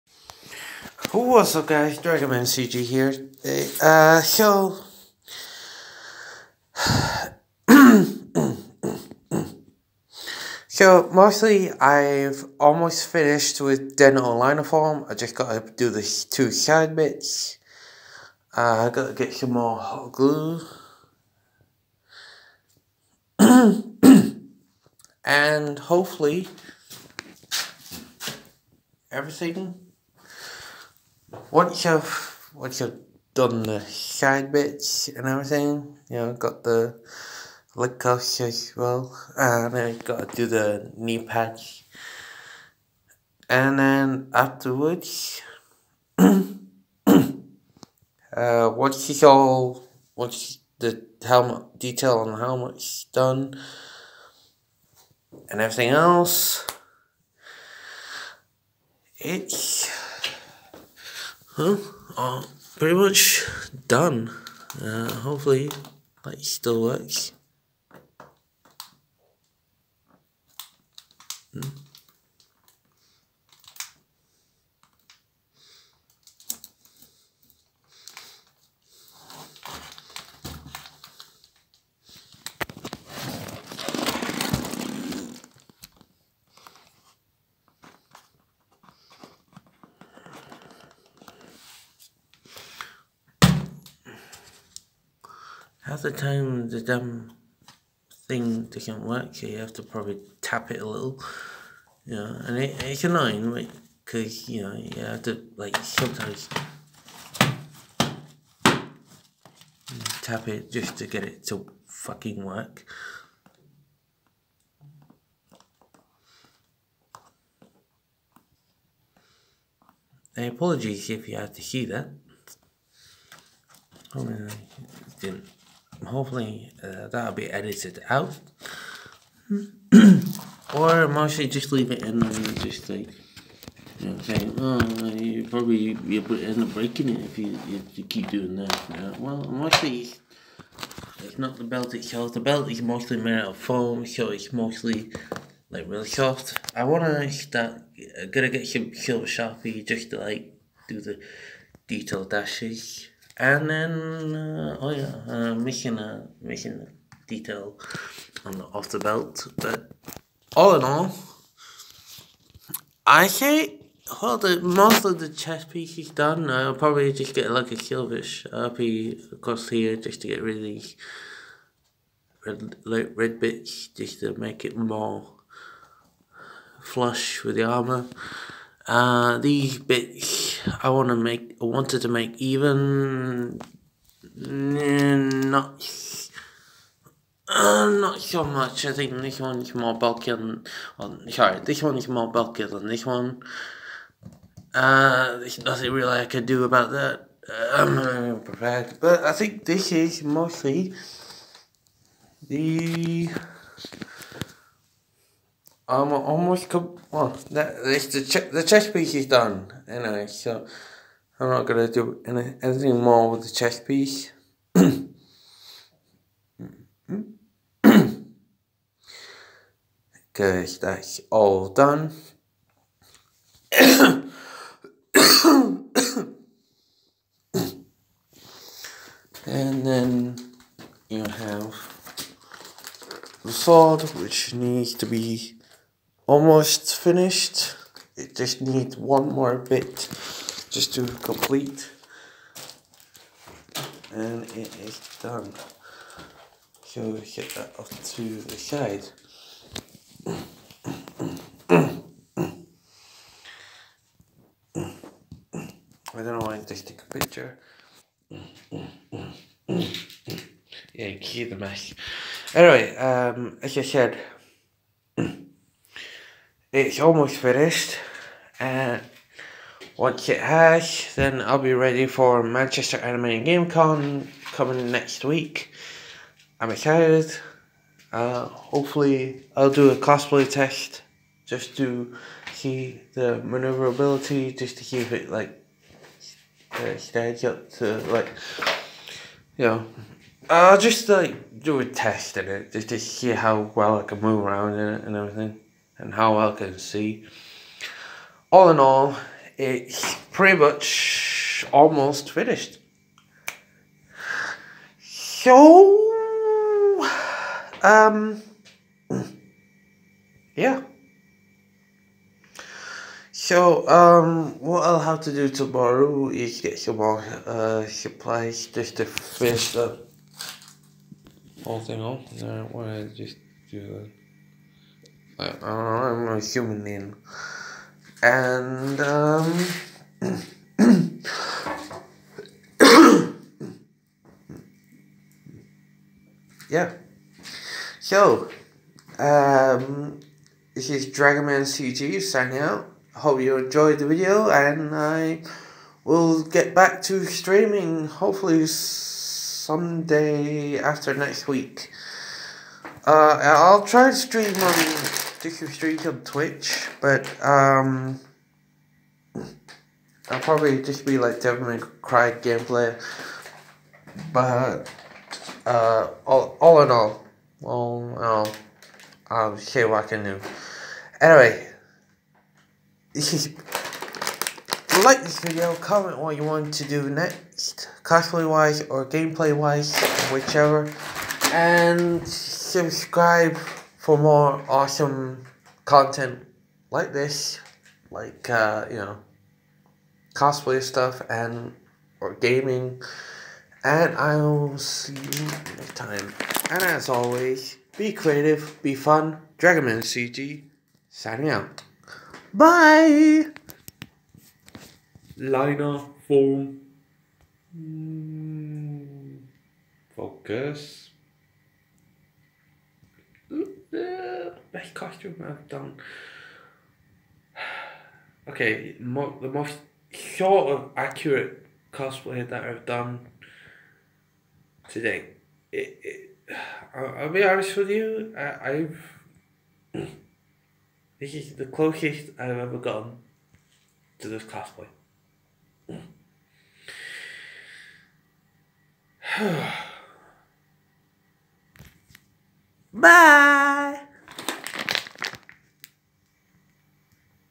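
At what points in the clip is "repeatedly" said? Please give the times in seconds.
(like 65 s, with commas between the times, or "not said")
not said.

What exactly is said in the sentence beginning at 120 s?
I apologize if you had to see that.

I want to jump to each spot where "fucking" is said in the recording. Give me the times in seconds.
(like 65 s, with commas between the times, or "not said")
111 s.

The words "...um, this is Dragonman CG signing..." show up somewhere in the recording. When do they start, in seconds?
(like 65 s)
339 s.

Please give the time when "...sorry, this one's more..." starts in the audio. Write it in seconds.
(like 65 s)
191 s.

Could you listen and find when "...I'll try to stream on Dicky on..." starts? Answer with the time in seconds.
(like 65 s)
353 s.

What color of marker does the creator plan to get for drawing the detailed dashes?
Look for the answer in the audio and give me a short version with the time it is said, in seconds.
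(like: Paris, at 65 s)
Silver, at 148 s.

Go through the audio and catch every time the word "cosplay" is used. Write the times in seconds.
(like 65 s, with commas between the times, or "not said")
279 s, 378 s, 390 s, 421 s, 434 s.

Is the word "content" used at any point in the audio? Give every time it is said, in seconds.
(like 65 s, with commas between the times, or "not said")
385 s.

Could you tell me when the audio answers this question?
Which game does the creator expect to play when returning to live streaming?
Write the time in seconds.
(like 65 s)
361 s.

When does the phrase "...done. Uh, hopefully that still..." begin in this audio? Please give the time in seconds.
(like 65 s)
63 s.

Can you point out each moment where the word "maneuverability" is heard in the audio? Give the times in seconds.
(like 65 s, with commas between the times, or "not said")
283 s.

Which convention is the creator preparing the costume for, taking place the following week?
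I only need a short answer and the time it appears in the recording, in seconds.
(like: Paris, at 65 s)
Manchester Anime and Game Con, at 272 s.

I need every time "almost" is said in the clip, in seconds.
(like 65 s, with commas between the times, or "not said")
12 s, 206 s, 236 s, 267 s, 301 s.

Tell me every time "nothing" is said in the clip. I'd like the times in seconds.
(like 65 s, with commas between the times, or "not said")
195 s.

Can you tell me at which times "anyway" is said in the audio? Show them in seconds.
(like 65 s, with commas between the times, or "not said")
209 s, 262 s, 371 s.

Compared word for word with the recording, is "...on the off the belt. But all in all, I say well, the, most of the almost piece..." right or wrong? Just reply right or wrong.
wrong.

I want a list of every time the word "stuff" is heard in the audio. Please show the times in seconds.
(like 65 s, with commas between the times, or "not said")
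390 s.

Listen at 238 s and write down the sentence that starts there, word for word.
It just needs one more bit just to complete.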